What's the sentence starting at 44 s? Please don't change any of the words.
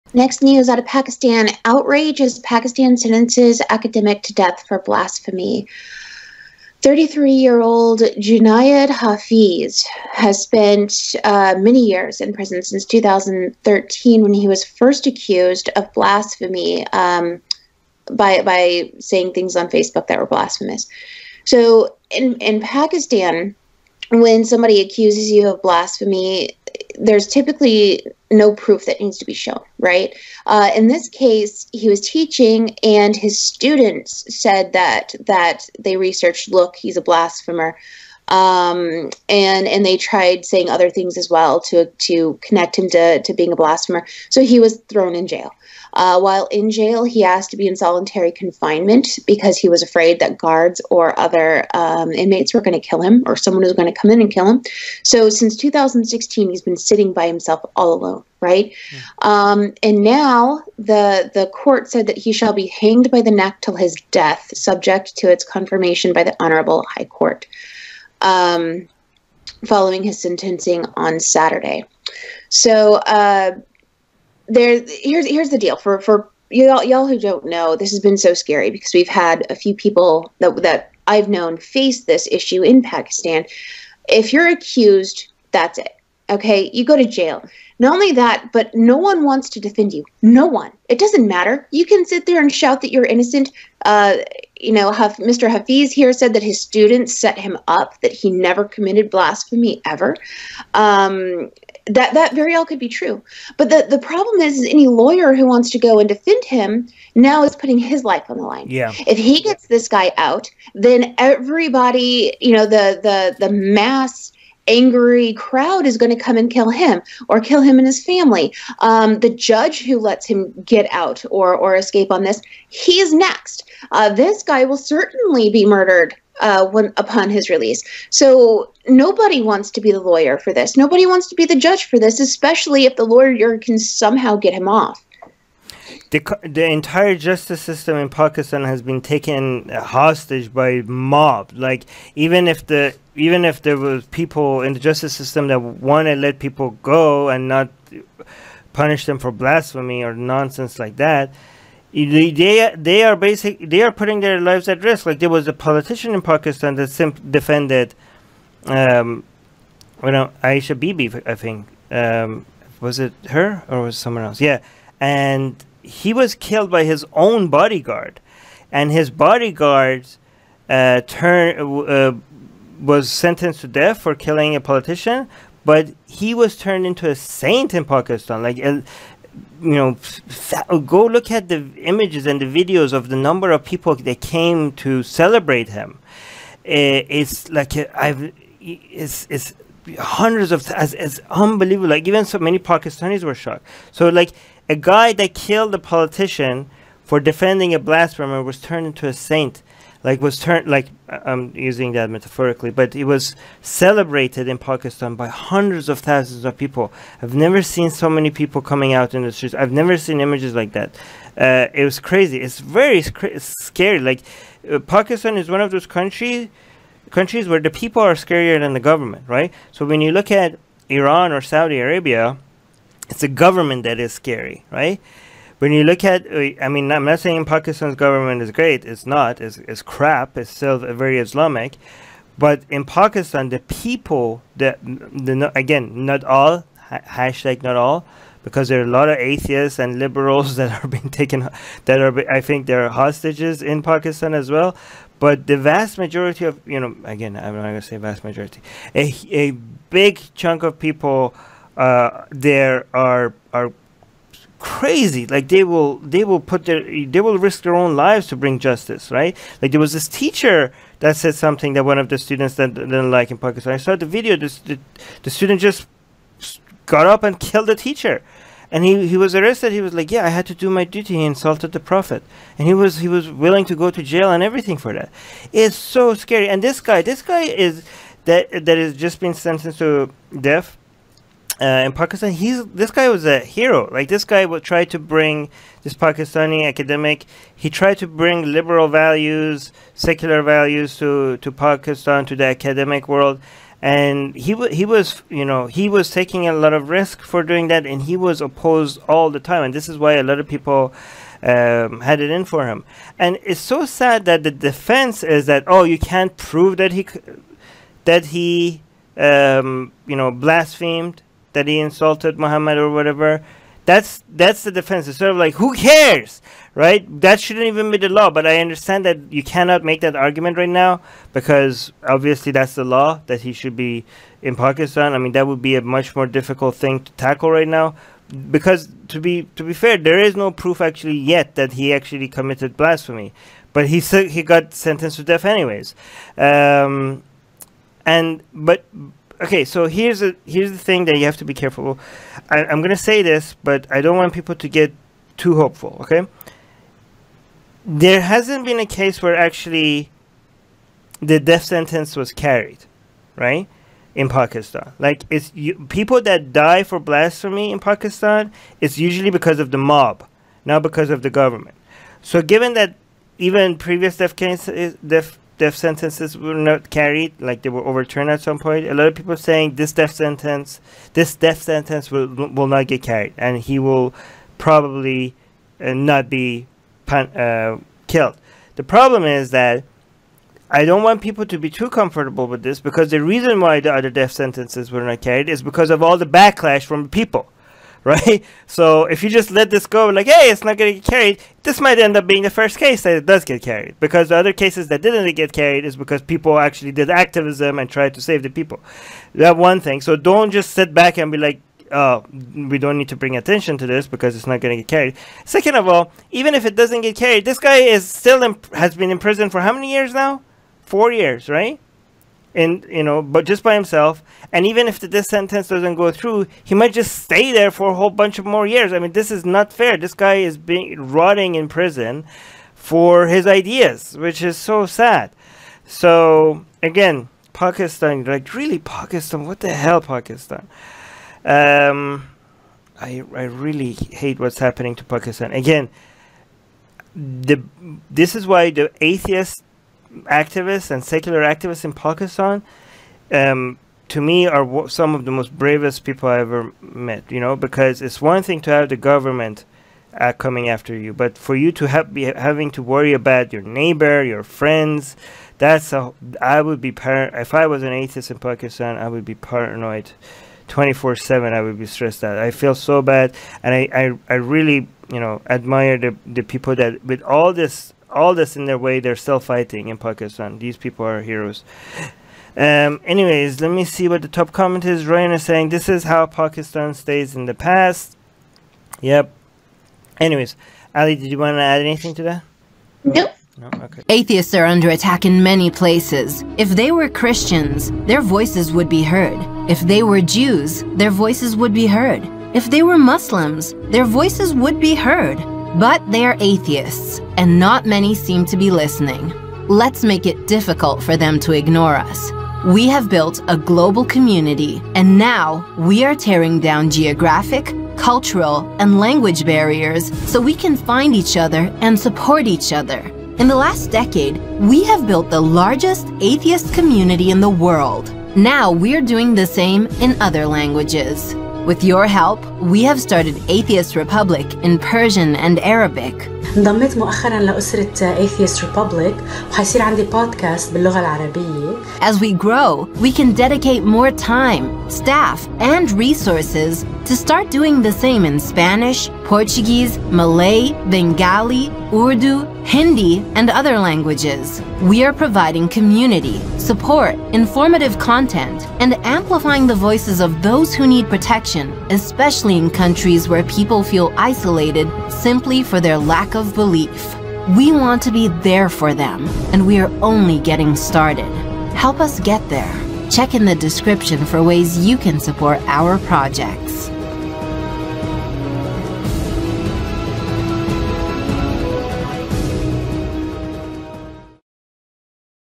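So he was thrown in jail.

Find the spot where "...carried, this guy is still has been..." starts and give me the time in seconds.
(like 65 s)
407 s.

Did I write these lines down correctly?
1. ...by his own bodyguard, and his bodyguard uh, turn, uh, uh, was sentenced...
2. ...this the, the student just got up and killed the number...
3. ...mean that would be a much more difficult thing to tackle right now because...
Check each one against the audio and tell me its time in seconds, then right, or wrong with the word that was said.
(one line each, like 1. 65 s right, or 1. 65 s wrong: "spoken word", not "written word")
1. 166 s right
2. 264 s wrong: "teacher", not "number"
3. 325 s right.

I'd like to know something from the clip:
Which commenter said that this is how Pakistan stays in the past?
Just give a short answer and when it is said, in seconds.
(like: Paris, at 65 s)
Ryan, at 475 s.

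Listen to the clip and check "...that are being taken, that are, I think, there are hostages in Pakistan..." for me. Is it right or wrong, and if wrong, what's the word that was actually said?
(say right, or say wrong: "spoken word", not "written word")
right.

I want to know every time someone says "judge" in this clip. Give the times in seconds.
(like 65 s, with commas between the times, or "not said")
119 s, 131 s.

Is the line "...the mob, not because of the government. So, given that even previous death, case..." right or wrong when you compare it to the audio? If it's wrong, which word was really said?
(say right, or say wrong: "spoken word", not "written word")
right.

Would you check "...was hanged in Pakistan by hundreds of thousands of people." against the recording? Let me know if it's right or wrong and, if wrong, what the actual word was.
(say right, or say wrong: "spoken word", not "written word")
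wrong: "celebrated", not "hanged".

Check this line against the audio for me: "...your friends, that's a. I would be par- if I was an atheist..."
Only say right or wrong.
right.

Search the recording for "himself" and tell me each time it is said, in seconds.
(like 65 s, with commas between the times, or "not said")
57 s, 413 s.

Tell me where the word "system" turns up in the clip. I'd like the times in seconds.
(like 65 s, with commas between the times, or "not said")
137 s, 145 s.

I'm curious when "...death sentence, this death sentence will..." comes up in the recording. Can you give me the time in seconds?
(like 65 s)
369 s.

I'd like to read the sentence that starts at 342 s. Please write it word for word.
I, I'm gonna say this, but I don't want people to get too hopeful.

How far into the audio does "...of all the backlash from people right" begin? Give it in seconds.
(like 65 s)
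385 s.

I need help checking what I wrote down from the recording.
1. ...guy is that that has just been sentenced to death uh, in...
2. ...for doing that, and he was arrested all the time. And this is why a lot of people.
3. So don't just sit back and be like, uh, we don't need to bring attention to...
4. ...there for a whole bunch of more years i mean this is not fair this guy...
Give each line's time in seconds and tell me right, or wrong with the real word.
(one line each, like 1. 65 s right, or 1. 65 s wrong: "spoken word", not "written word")
1. 277 s right
2. 297 s wrong: "opposed", not "arrested"
3. 400 s right
4. 417 s right.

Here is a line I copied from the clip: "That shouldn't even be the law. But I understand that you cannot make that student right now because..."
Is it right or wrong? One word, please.
wrong.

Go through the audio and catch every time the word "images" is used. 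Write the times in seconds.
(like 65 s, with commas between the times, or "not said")
181 s, 210 s.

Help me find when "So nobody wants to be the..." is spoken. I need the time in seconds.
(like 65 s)
128 s.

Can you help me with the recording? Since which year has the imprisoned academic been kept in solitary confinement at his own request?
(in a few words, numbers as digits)
2016.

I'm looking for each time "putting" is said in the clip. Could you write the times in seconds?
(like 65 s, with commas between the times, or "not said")
107 s, 153 s.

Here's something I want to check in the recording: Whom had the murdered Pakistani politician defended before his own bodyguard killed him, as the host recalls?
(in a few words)
Aisha Bibi.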